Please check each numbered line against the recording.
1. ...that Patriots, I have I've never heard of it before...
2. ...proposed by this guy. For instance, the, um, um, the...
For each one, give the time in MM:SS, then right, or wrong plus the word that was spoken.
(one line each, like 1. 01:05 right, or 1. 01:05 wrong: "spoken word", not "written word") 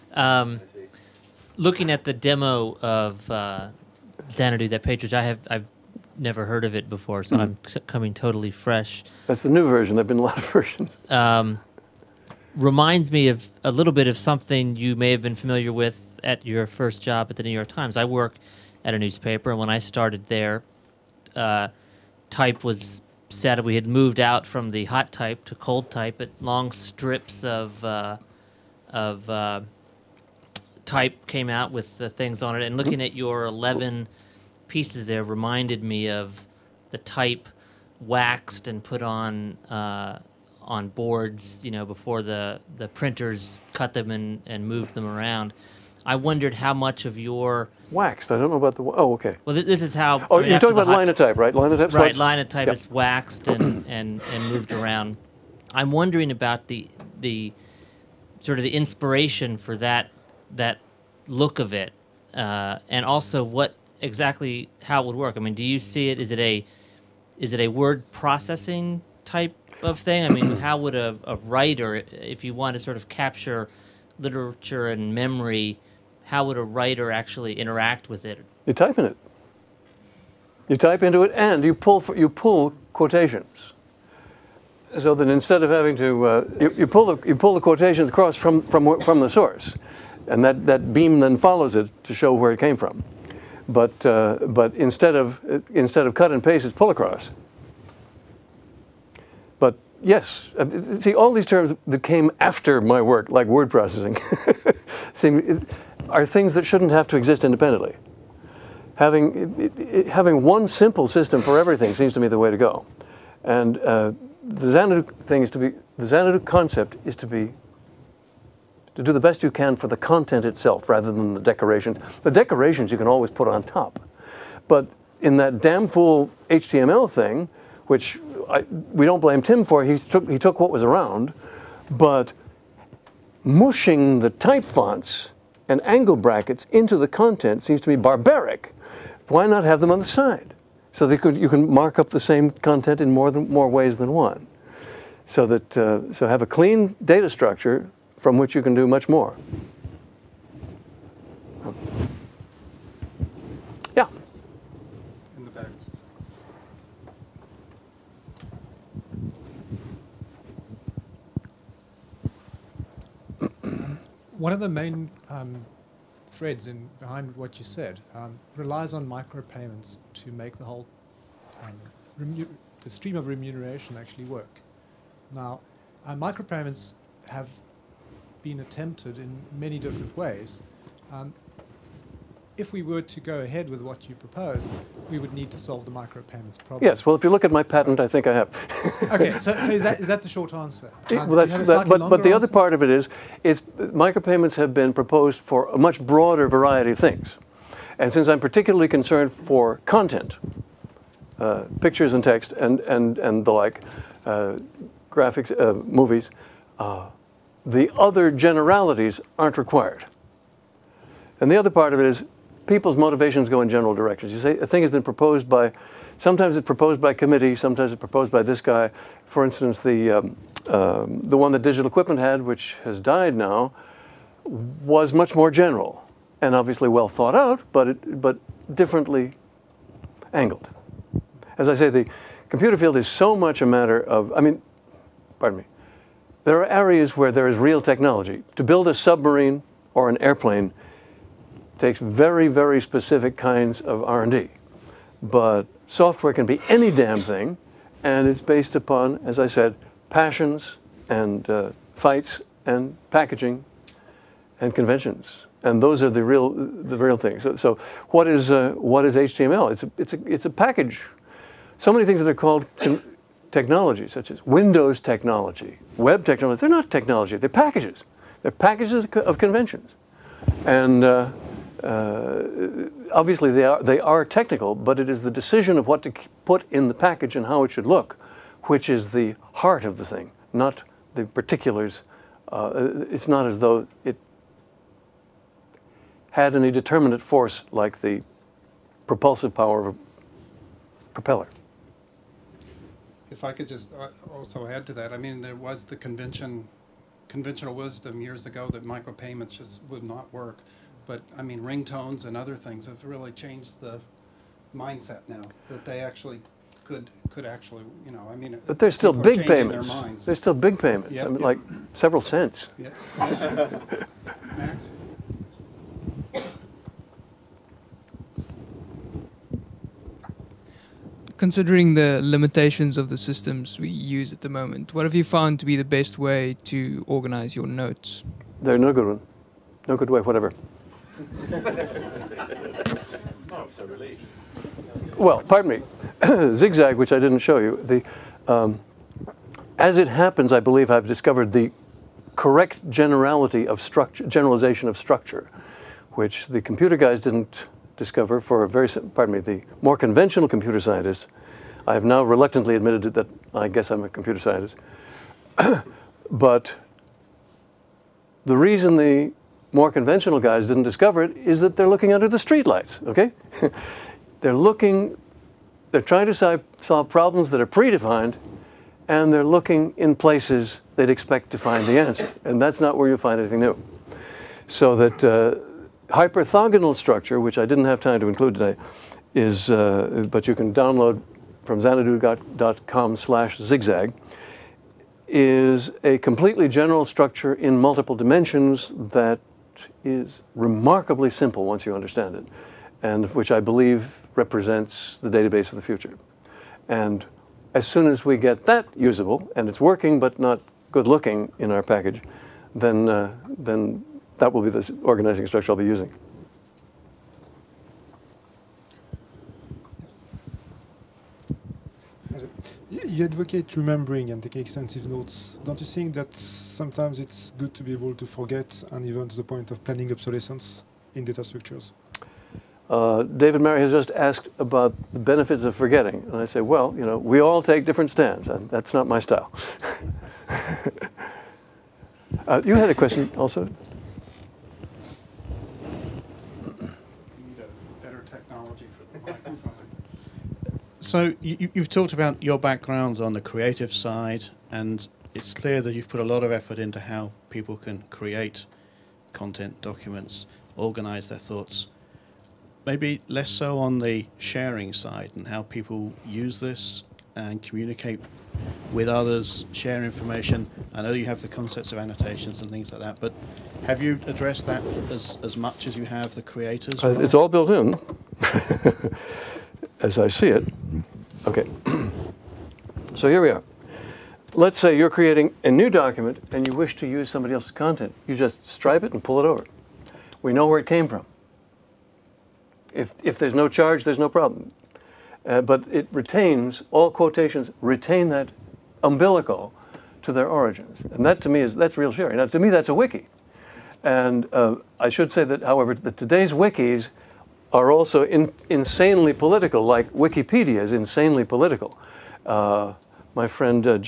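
1. 00:04 right
2. 03:37 right.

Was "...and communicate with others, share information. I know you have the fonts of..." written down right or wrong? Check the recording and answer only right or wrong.
wrong.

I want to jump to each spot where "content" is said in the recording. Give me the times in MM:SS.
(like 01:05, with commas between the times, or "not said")
01:59, 02:17, 02:22, 03:19, 07:29, 07:57.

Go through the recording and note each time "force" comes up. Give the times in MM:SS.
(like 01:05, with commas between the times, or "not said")
04:47.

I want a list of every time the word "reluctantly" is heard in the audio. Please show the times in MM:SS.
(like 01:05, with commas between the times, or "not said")
05:52.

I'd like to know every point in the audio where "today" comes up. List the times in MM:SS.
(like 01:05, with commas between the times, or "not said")
06:18, 08:16.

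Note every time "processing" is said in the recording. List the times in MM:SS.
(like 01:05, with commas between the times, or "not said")
01:08, 01:43.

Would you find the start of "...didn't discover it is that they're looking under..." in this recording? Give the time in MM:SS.
06:00.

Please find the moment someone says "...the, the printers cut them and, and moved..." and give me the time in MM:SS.
00:42.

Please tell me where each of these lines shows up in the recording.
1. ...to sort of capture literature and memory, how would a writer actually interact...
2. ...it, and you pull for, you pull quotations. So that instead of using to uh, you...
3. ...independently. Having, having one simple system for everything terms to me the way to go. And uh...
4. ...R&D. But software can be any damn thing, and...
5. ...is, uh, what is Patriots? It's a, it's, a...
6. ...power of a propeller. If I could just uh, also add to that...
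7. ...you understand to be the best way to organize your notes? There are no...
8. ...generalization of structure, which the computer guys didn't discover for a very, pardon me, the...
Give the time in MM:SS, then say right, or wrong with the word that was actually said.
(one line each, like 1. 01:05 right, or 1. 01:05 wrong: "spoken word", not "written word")
1. 01:12 right
2. 01:21 wrong: "having", not "using"
3. 01:47 wrong: "seems", not "terms"
4. 04:04 right
5. 04:18 wrong: "HTML", not "Patriots"
6. 04:49 right
7. 05:25 wrong: "found", not "understand"
8. 05:44 right.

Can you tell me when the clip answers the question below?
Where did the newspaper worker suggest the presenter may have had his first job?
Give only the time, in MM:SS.
00:17.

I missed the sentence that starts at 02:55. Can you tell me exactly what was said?
Now, uh, micropayments have been attempted in many different ways.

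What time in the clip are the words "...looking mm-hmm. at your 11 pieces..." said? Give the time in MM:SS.
00:32.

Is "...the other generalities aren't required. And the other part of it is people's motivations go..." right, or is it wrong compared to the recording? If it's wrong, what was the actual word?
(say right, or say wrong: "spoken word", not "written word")
right.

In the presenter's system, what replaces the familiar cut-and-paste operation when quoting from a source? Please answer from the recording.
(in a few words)
Pull across.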